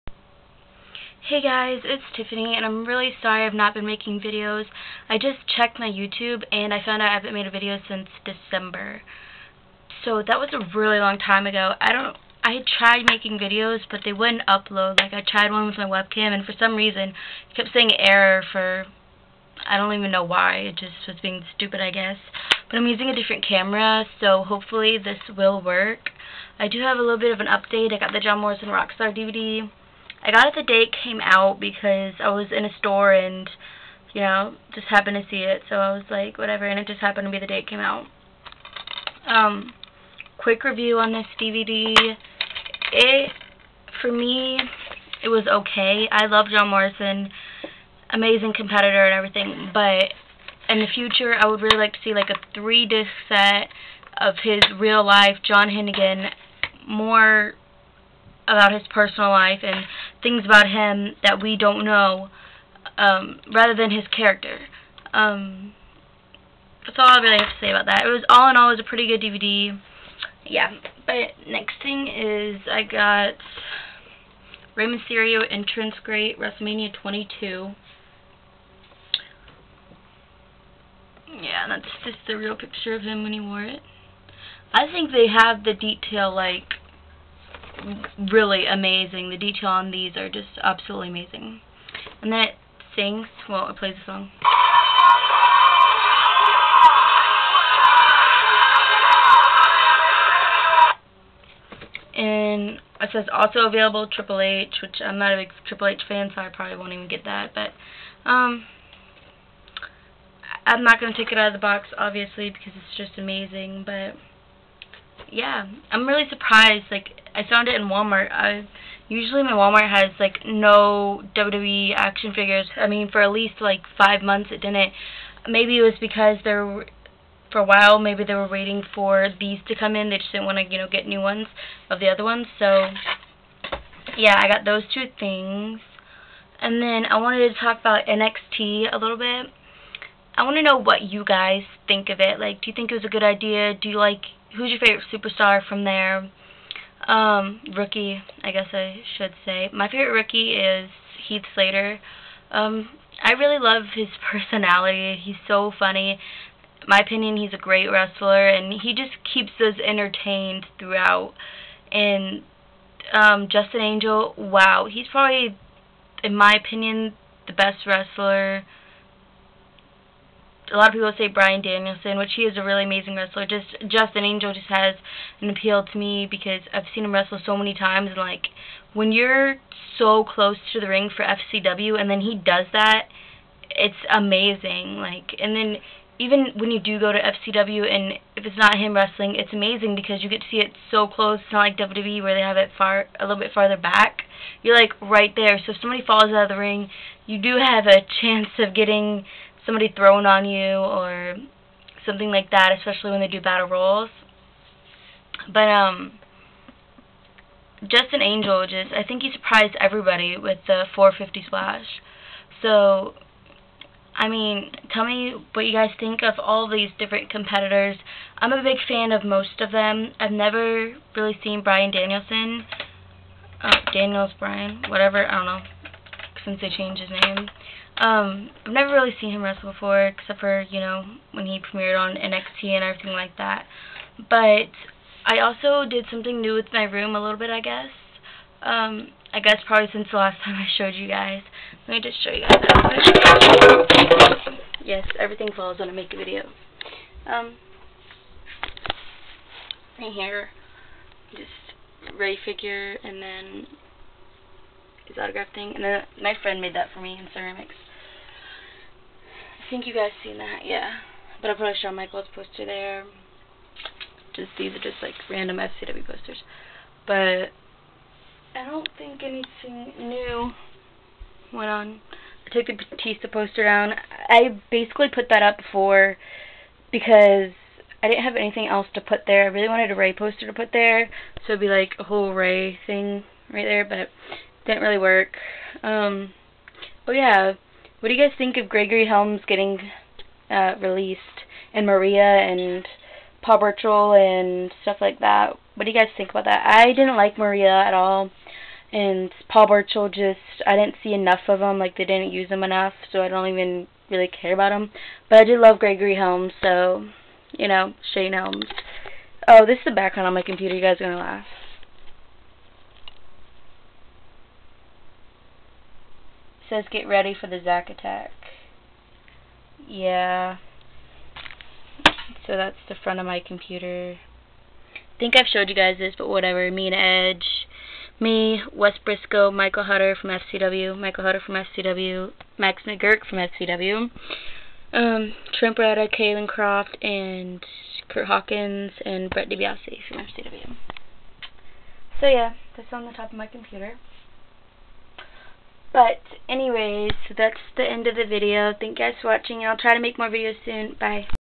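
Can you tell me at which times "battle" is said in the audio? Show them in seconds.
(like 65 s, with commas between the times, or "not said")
203 s.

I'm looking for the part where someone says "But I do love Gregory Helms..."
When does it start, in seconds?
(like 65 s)
305 s.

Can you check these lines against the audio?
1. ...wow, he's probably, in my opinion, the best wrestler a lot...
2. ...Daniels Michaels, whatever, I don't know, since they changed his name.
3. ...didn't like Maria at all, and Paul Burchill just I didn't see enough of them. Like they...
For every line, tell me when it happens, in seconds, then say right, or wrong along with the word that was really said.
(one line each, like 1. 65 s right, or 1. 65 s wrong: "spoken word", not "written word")
1. 164 s right
2. 223 s wrong: "Brian", not "Michaels"
3. 296 s right.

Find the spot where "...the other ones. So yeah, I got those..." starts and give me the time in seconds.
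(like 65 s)
131 s.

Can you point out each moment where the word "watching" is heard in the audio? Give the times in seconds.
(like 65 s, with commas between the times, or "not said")
349 s.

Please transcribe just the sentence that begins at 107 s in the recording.
But um, I'm not going to take it out of the box, obviously, because it's just amazing.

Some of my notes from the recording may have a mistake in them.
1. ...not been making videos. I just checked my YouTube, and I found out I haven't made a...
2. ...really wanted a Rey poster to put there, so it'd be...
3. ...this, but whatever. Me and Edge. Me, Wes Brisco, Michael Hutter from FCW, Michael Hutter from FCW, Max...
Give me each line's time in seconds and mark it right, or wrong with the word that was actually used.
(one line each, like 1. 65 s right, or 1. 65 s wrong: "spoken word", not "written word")
1. 3 s right
2. 279 s right
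3. 325 s right.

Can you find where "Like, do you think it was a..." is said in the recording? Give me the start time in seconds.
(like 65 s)
142 s.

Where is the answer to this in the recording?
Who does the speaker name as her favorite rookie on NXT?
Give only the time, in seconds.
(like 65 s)
151 s.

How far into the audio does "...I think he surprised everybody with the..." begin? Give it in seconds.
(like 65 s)
208 s.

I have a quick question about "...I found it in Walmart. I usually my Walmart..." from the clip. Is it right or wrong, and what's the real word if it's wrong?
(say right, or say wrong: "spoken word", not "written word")
right.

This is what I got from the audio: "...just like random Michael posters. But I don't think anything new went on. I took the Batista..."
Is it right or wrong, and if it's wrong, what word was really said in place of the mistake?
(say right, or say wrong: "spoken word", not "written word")
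wrong: "FCW", not "Michael".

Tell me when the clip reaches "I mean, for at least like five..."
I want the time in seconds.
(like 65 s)
122 s.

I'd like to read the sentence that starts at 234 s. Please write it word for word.
But I also did something new with my room a little bit, I guess.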